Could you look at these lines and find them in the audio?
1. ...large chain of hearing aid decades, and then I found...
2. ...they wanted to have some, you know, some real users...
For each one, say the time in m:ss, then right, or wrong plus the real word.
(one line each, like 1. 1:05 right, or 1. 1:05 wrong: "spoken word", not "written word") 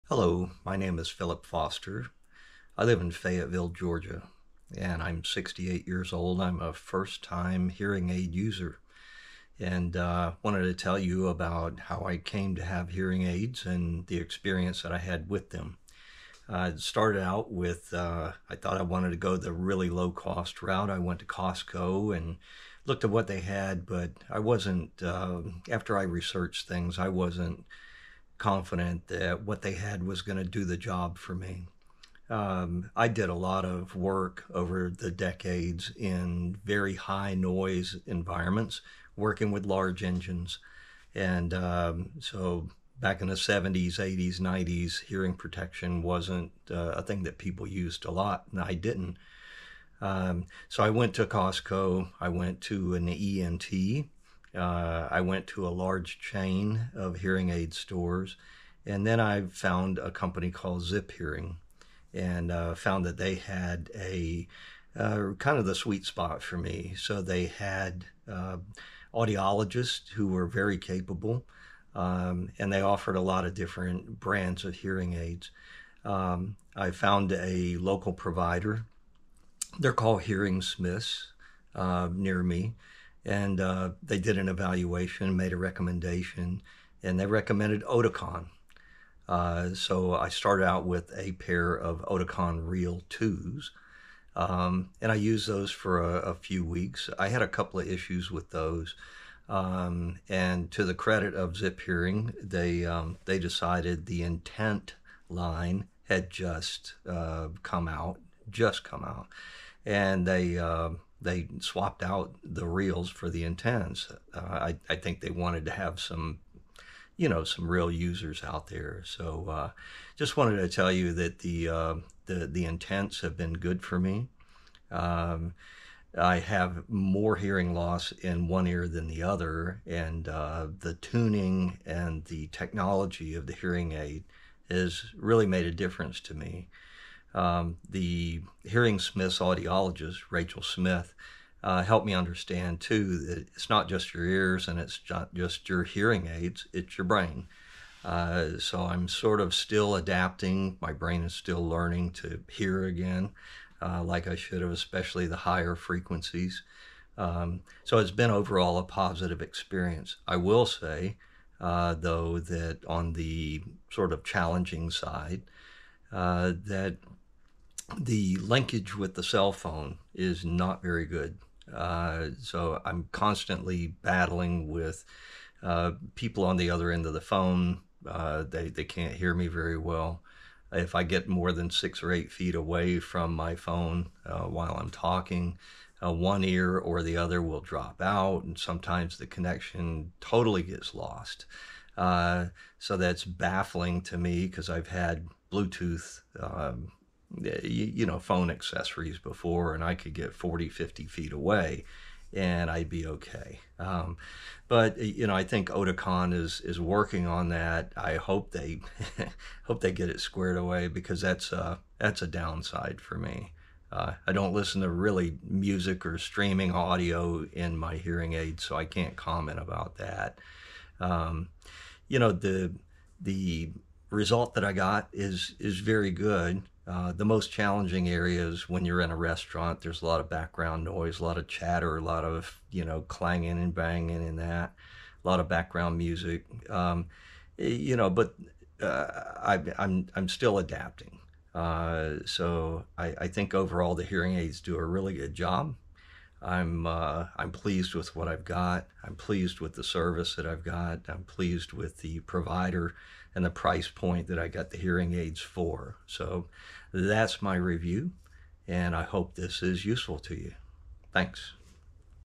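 1. 0:55 wrong: "stores", not "decades"
2. 1:55 right.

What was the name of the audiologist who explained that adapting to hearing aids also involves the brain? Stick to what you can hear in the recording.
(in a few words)
Rachel Smith.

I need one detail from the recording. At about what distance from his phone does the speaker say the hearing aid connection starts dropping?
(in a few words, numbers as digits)
6 or 8 feet.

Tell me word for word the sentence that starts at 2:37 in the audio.
Um, so it's been overall a positive experience.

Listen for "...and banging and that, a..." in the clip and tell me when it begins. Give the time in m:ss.
3:53.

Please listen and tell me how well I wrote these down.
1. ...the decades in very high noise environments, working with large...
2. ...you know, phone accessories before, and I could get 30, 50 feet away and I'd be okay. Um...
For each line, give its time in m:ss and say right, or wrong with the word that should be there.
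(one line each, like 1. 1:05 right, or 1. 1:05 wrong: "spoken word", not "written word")
1. 0:34 right
2. 3:17 wrong: "40", not "30".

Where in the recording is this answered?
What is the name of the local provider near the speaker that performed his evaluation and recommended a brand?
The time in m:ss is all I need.
1:20.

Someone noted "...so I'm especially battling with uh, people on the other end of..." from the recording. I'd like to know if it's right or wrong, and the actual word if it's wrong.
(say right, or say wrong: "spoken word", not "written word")
wrong: "constantly", not "especially".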